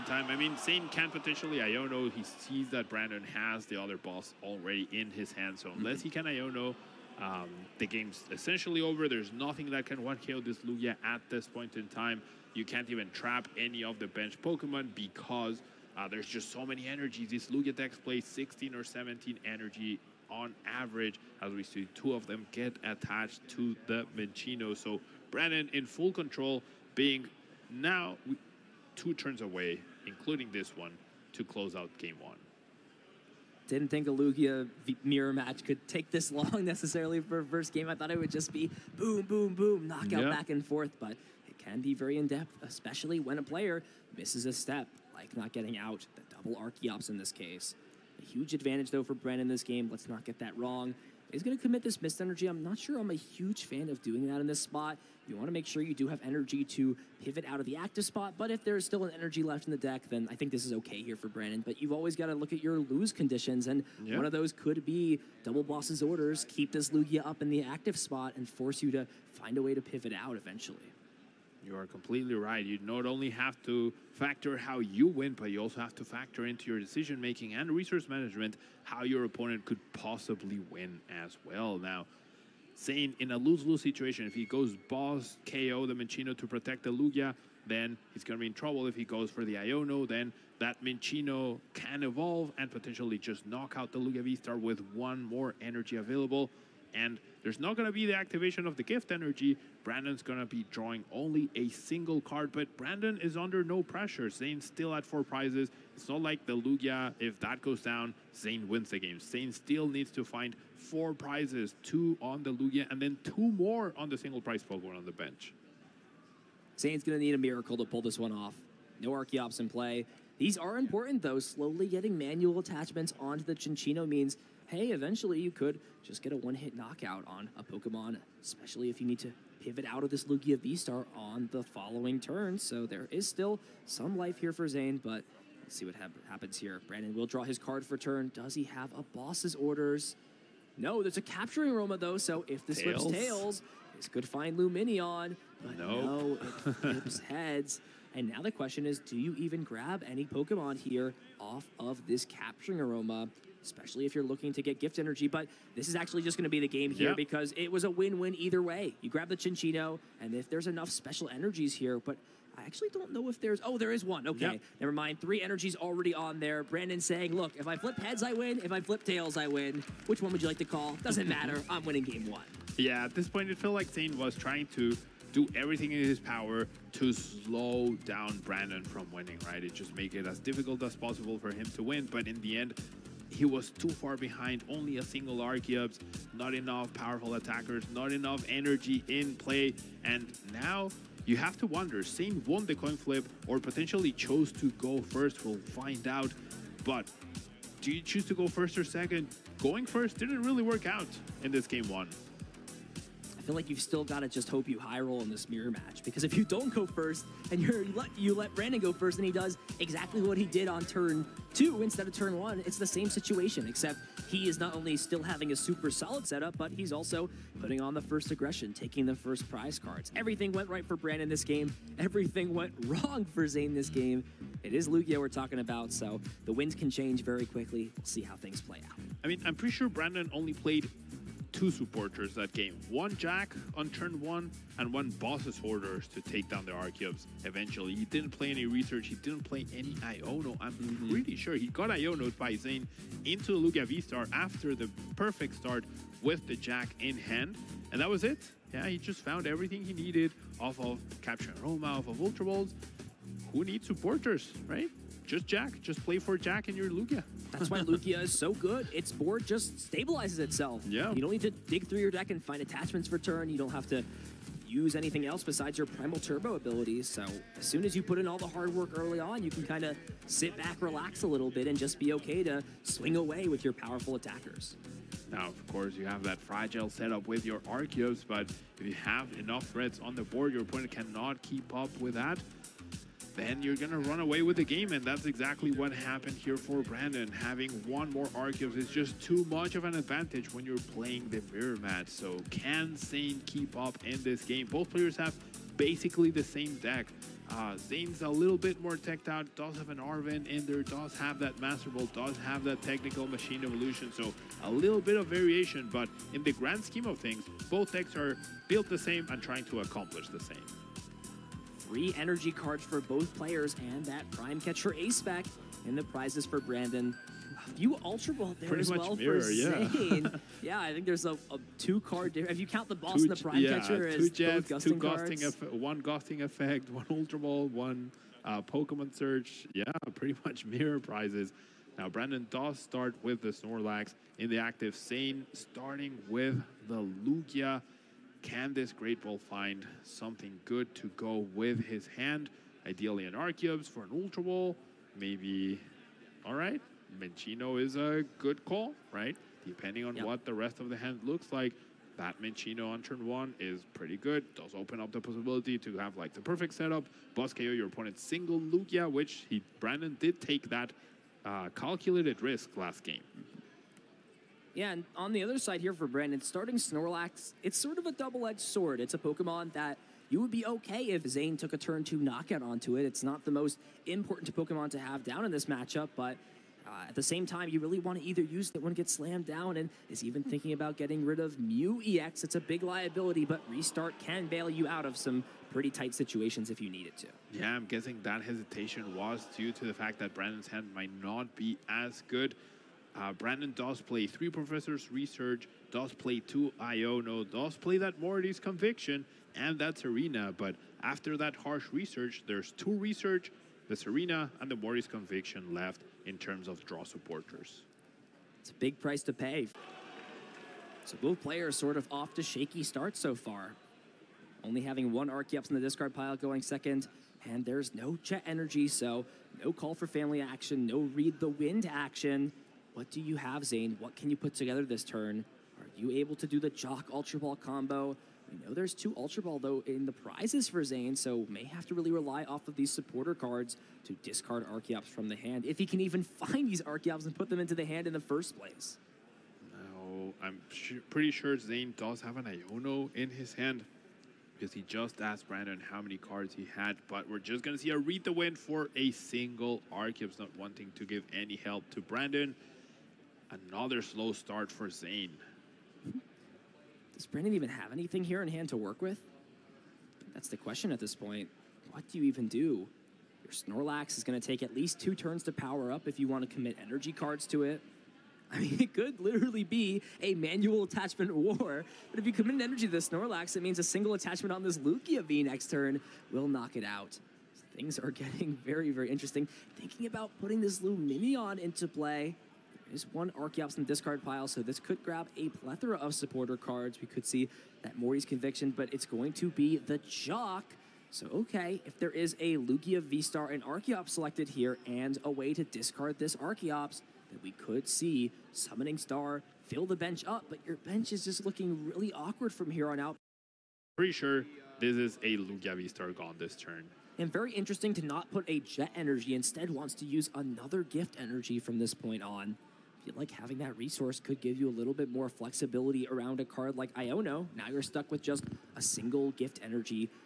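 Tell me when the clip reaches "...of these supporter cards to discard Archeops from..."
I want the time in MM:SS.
07:12.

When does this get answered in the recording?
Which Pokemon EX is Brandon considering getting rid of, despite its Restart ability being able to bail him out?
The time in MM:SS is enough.
06:21.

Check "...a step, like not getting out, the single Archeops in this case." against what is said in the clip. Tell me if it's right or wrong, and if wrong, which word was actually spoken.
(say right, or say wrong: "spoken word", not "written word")
wrong: "double", not "single".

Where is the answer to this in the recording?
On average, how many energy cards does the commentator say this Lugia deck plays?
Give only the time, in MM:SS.
00:18.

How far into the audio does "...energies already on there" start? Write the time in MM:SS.
02:45.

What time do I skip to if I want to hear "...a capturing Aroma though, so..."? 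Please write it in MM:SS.
02:21.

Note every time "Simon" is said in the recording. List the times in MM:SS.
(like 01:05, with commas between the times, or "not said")
not said.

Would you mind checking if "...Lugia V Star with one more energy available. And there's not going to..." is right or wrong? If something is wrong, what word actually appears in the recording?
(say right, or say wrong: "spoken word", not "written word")
right.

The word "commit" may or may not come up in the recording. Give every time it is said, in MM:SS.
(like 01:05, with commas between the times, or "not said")
00:51, 07:46, 07:52.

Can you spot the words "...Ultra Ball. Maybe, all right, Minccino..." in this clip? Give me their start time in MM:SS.
05:44.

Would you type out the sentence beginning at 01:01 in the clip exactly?
But you've always got to look at your lose conditions, and yep.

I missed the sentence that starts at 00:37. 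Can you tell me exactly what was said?
I thought it would just be boom, boom, boom, knockout yep.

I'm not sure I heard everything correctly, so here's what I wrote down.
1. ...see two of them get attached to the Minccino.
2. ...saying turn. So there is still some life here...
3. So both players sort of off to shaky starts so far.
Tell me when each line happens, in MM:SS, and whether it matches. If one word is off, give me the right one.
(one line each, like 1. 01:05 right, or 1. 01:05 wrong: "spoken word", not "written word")
1. 00:21 right
2. 02:11 wrong: "following", not "saying"
3. 06:51 right.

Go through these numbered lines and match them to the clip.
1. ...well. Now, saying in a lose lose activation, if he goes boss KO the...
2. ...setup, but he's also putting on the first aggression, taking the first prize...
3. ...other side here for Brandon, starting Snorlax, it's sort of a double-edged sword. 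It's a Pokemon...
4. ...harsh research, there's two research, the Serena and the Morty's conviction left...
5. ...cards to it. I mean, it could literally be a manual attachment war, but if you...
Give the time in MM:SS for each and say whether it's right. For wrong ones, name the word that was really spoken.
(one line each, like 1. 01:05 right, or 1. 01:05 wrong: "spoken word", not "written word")
1. 01:21 wrong: "situation", not "activation"
2. 03:36 right
3. 06:05 right
4. 06:41 right
5. 07:47 right.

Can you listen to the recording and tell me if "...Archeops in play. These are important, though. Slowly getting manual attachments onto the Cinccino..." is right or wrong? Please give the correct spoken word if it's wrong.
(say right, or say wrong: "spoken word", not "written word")
right.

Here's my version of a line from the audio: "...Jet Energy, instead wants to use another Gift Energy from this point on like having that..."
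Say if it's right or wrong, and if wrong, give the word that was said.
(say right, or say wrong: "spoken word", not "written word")
right.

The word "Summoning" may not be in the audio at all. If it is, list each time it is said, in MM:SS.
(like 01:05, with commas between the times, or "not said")
08:18.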